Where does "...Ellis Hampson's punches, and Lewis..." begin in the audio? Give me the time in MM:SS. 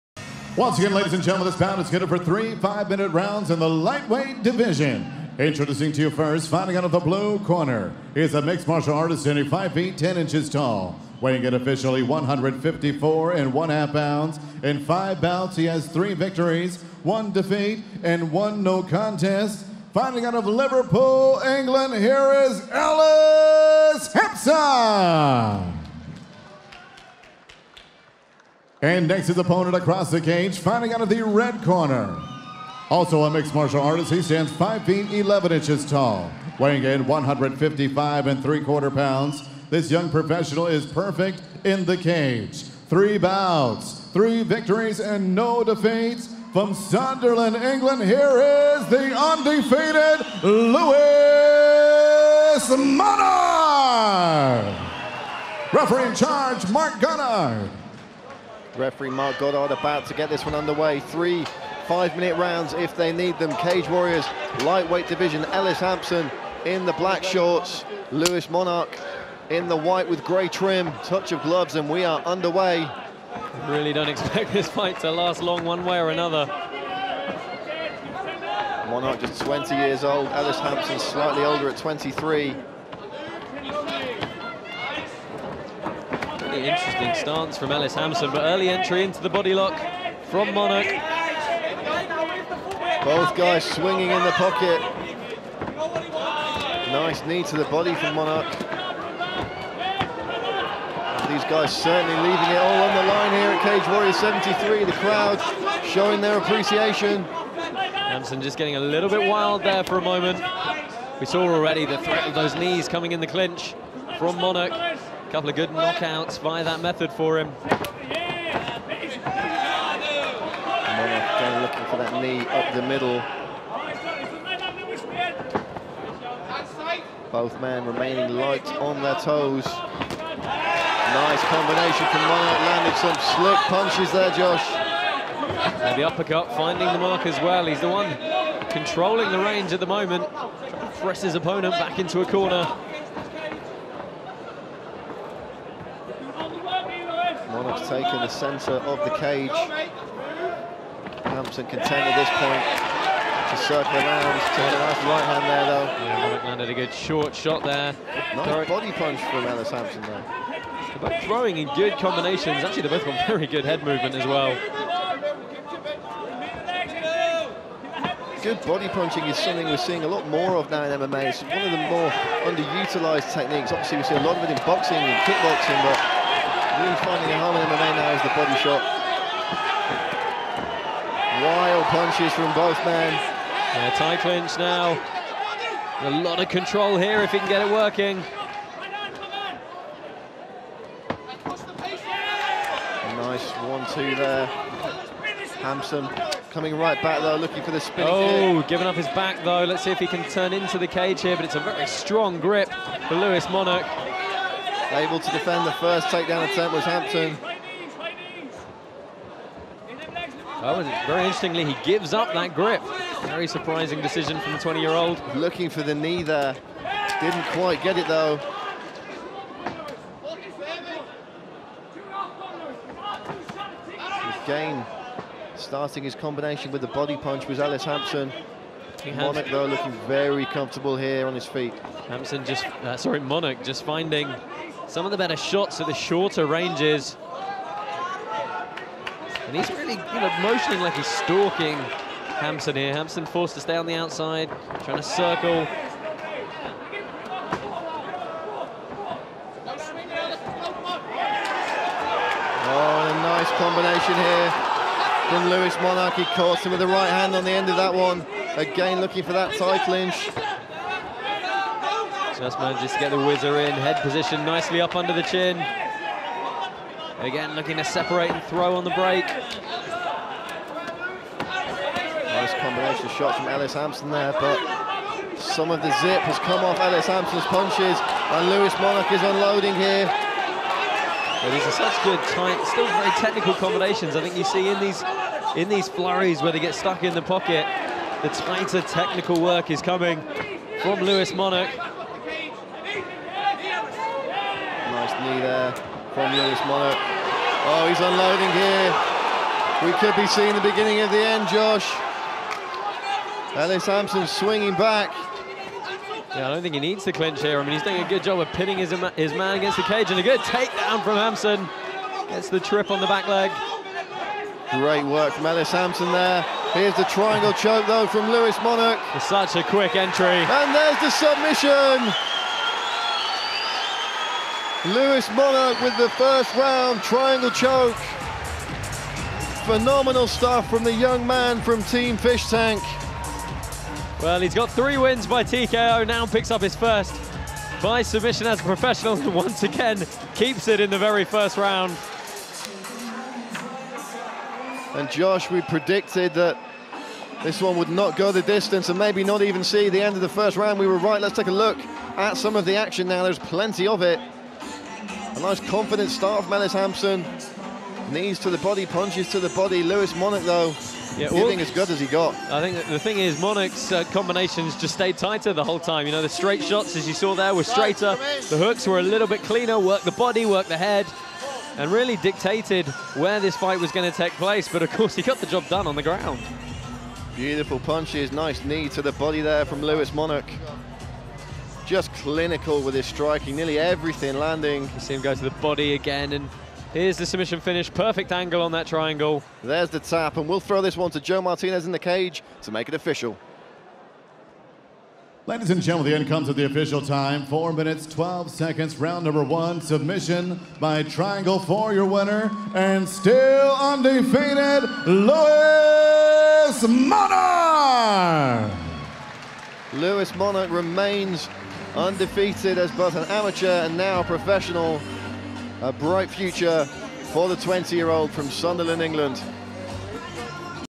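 04:36.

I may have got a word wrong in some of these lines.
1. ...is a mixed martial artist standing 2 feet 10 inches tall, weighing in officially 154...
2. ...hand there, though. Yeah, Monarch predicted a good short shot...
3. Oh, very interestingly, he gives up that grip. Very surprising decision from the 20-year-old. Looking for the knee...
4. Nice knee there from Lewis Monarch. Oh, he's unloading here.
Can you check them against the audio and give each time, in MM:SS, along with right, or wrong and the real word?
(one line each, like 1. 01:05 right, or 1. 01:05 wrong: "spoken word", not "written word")
1. 00:08 wrong: "5", not "2"
2. 02:35 wrong: "landed", not "predicted"
3. 03:30 right
4. 04:55 right.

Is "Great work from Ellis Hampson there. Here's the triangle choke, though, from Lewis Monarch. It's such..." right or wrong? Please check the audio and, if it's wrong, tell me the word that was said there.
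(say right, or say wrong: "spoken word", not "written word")
right.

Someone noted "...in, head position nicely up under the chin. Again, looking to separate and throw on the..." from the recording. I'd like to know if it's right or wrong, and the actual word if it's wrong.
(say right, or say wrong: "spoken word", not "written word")
right.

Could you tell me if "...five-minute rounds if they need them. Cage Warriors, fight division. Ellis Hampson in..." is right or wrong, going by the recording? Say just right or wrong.
wrong.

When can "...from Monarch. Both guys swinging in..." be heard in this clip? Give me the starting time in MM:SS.
01:30.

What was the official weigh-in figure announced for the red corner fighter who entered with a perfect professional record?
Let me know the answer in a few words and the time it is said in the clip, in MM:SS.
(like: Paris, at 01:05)
155 3/4 pounds, at 00:37.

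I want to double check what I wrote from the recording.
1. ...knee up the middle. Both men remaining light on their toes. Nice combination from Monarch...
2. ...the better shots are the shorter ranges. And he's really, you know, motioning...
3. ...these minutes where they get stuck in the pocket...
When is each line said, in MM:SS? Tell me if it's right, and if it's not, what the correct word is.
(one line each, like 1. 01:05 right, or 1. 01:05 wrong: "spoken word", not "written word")
1. 02:02 right
2. 03:55 right
3. 04:45 wrong: "flurries", not "minutes".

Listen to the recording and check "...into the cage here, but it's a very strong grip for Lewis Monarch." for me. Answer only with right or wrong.
right.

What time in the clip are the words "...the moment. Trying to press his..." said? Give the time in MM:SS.
02:19.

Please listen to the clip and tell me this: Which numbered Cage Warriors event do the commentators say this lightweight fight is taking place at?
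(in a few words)
Cage Warriors 73.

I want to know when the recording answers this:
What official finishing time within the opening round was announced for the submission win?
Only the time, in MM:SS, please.
06:37.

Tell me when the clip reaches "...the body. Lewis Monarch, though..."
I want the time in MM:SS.
05:59.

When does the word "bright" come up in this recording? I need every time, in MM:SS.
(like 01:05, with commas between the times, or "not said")
06:55.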